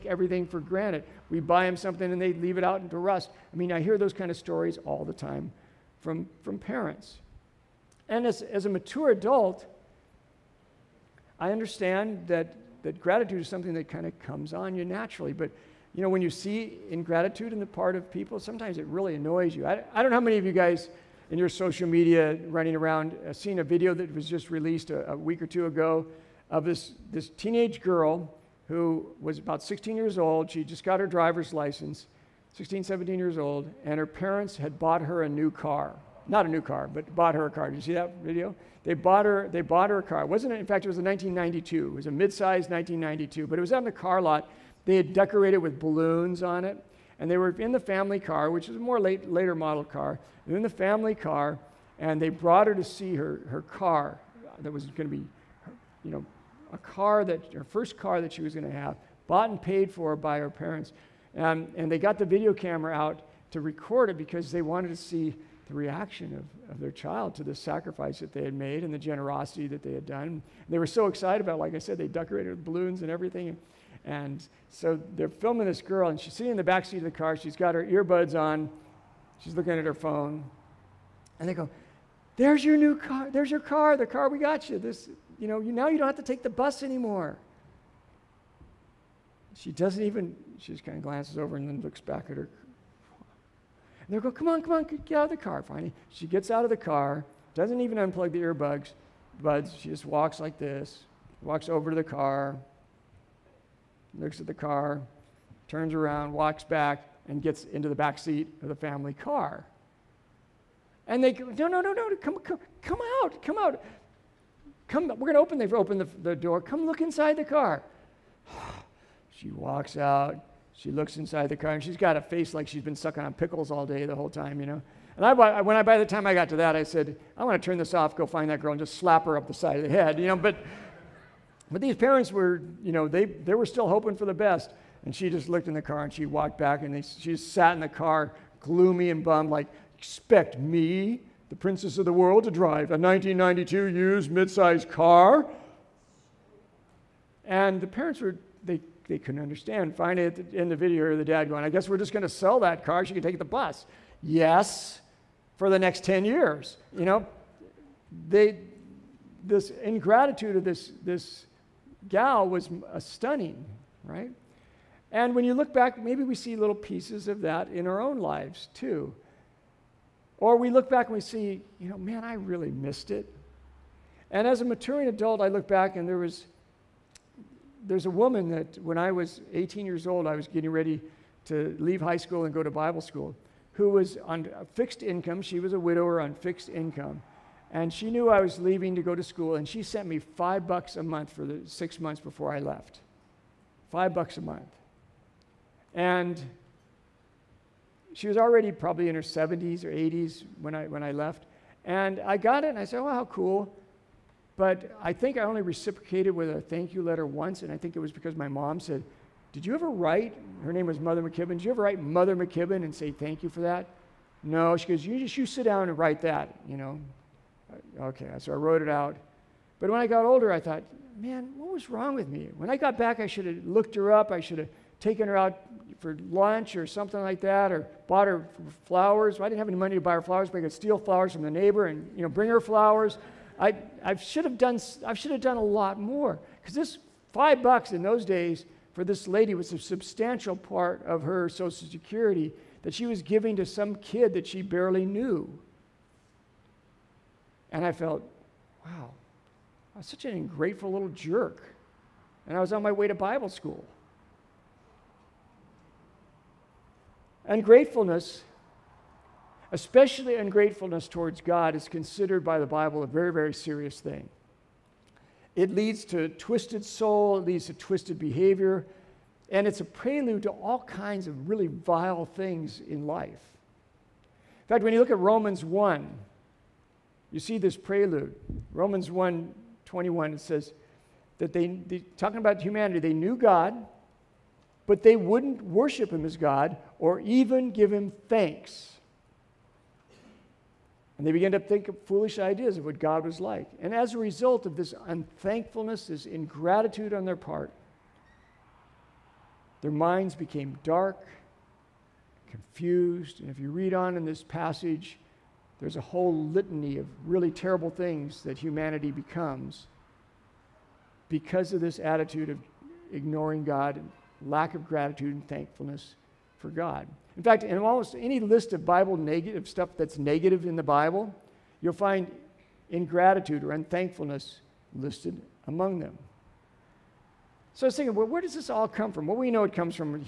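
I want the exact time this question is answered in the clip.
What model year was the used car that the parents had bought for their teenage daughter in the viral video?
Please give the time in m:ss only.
0:40.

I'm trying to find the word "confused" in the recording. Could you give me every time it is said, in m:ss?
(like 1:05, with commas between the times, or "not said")
5:02.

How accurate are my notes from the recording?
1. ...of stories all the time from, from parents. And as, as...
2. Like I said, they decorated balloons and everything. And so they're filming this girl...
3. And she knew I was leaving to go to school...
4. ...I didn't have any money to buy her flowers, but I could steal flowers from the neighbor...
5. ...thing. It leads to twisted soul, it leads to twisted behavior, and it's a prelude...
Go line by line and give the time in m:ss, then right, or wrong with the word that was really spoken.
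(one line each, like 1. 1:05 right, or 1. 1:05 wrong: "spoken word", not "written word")
1. 0:04 right
2. 1:11 right
3. 3:07 right
4. 3:49 right
5. 4:23 right.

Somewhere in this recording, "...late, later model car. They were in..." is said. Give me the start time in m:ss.
0:48.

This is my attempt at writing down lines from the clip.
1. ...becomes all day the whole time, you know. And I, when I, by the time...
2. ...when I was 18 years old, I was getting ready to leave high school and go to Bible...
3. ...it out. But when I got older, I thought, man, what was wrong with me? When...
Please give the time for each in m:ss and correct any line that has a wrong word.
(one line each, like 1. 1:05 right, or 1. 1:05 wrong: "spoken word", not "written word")
1. 2:03 wrong: "pickles", not "becomes"
2. 2:58 right
3. 3:38 right.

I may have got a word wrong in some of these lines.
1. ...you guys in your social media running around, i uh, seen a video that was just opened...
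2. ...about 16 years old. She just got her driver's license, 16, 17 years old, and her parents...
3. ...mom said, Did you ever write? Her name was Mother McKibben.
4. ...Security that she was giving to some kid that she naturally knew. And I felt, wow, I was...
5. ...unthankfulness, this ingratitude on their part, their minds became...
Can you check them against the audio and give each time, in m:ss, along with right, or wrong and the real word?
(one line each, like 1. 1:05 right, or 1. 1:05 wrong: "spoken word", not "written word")
1. 0:20 wrong: "released", not "opened"
2. 0:29 right
3. 3:28 right
4. 4:01 wrong: "barely", not "naturally"
5. 4:55 right.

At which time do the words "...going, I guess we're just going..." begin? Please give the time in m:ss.
2:31.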